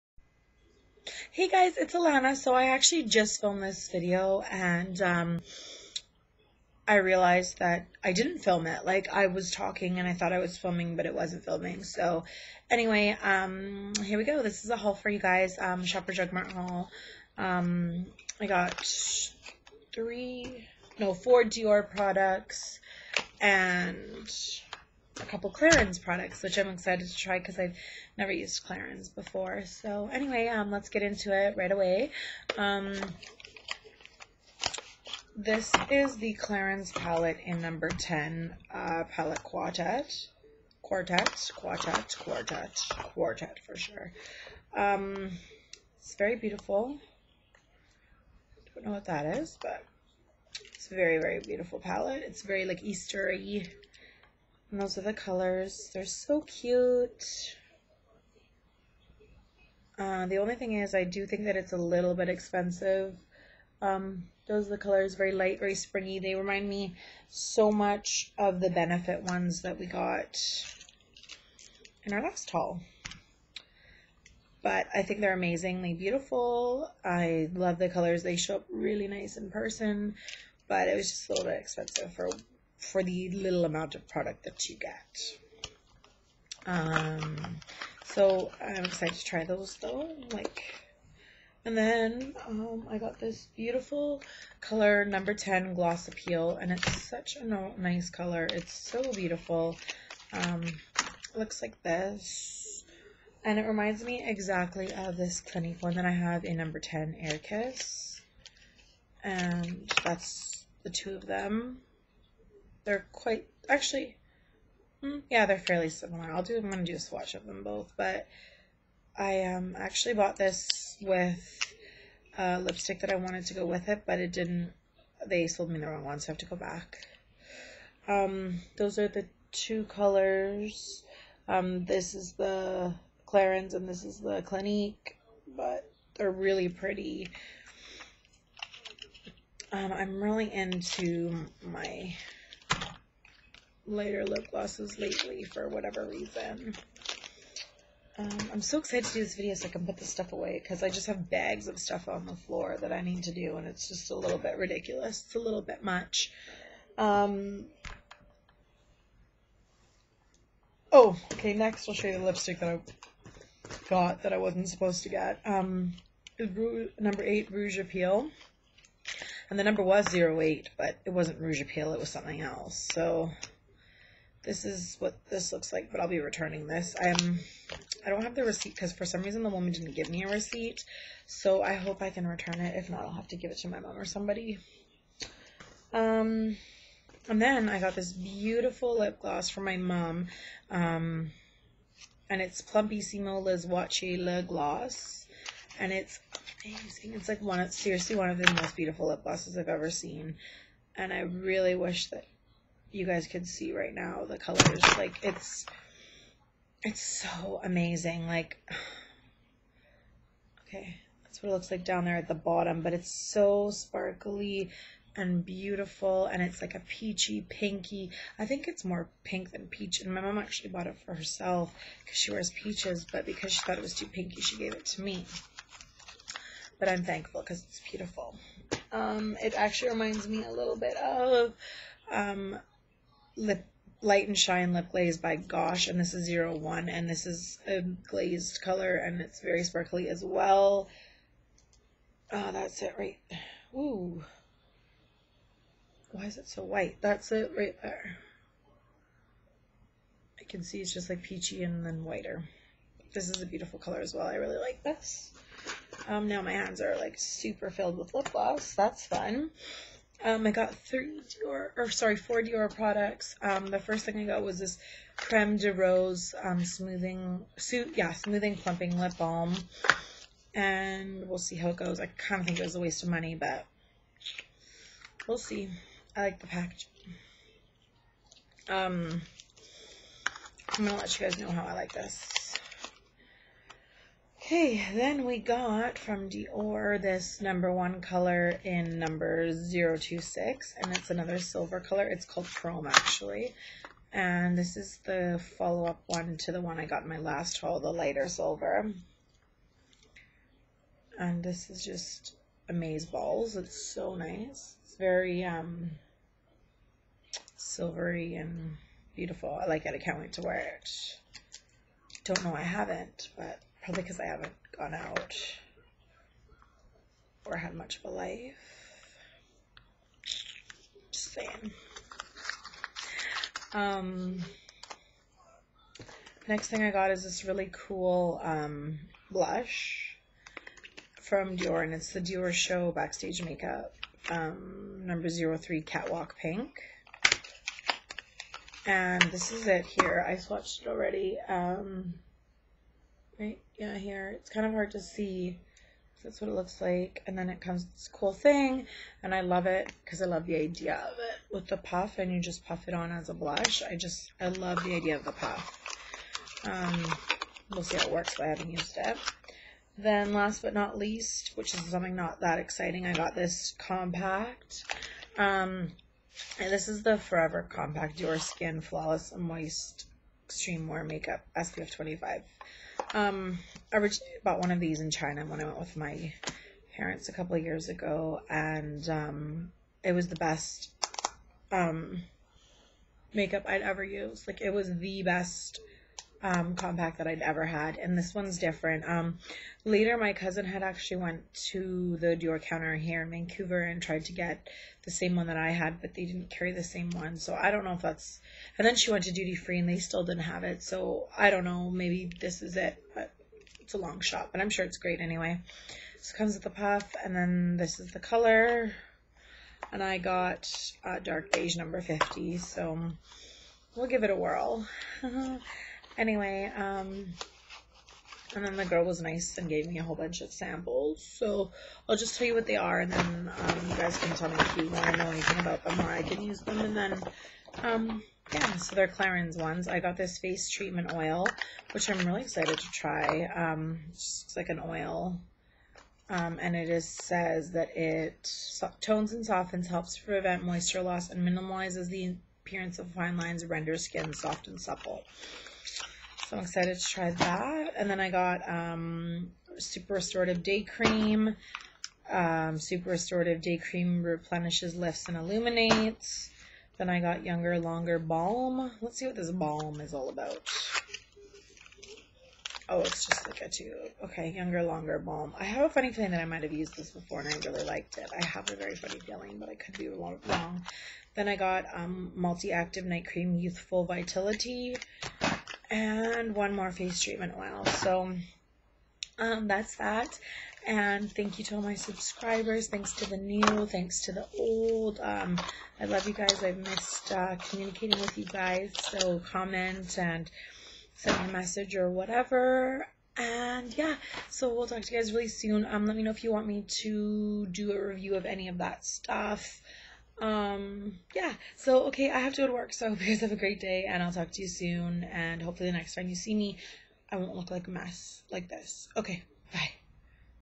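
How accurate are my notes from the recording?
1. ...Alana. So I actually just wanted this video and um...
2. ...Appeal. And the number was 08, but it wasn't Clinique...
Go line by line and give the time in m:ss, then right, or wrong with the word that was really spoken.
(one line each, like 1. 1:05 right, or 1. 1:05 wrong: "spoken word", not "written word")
1. 0:01 wrong: "filmed", not "wanted"
2. 2:47 wrong: "Rouge", not "Clinique".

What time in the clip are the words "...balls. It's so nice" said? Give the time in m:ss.
5:03.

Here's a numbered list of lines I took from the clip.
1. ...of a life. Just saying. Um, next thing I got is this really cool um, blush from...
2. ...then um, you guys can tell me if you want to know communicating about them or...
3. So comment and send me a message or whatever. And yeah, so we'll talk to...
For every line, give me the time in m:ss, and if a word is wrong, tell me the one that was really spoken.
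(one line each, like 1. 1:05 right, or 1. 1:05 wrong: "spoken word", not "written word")
1. 5:17 right
2. 7:03 wrong: "anything", not "communicating"
3. 8:08 right.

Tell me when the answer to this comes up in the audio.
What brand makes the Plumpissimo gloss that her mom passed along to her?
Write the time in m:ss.
3:13.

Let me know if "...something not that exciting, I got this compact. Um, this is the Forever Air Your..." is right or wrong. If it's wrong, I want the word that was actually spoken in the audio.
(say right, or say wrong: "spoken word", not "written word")
wrong: "Compact", not "Air".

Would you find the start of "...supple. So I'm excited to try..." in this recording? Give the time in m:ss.
7:24.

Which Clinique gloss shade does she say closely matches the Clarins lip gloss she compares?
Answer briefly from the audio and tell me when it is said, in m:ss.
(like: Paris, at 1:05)
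Air Kiss, at 1:47.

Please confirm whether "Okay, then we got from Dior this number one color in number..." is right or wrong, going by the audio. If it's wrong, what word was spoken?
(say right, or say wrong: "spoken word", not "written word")
right.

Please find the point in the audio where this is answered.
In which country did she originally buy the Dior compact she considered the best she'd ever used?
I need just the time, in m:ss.
6:15.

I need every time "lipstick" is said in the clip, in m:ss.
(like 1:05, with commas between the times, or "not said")
2:02, 2:42.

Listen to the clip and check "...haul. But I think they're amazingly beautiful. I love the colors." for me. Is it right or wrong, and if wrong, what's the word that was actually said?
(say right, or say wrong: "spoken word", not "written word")
right.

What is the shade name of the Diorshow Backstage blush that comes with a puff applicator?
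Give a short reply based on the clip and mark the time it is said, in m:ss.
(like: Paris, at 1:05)
Catwalk Pink, at 5:35.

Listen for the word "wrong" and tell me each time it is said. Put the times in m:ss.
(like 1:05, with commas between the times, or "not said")
2:05, 7:50.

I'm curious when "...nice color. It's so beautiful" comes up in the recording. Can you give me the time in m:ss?
1:37.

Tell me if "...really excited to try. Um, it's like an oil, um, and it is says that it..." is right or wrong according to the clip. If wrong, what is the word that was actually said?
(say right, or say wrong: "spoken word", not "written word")
right.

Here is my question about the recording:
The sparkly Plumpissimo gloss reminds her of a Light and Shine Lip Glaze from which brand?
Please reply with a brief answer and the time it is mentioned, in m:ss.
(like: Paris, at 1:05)
Gosh, at 3:55.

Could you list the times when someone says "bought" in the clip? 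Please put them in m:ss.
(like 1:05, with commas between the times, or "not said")
2:00, 3:40, 6:14.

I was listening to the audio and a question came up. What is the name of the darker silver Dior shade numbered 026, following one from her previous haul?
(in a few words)
Chrome.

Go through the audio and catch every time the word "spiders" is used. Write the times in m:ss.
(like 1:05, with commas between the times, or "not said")
not said.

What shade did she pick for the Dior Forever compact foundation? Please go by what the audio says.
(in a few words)
dark beige 50.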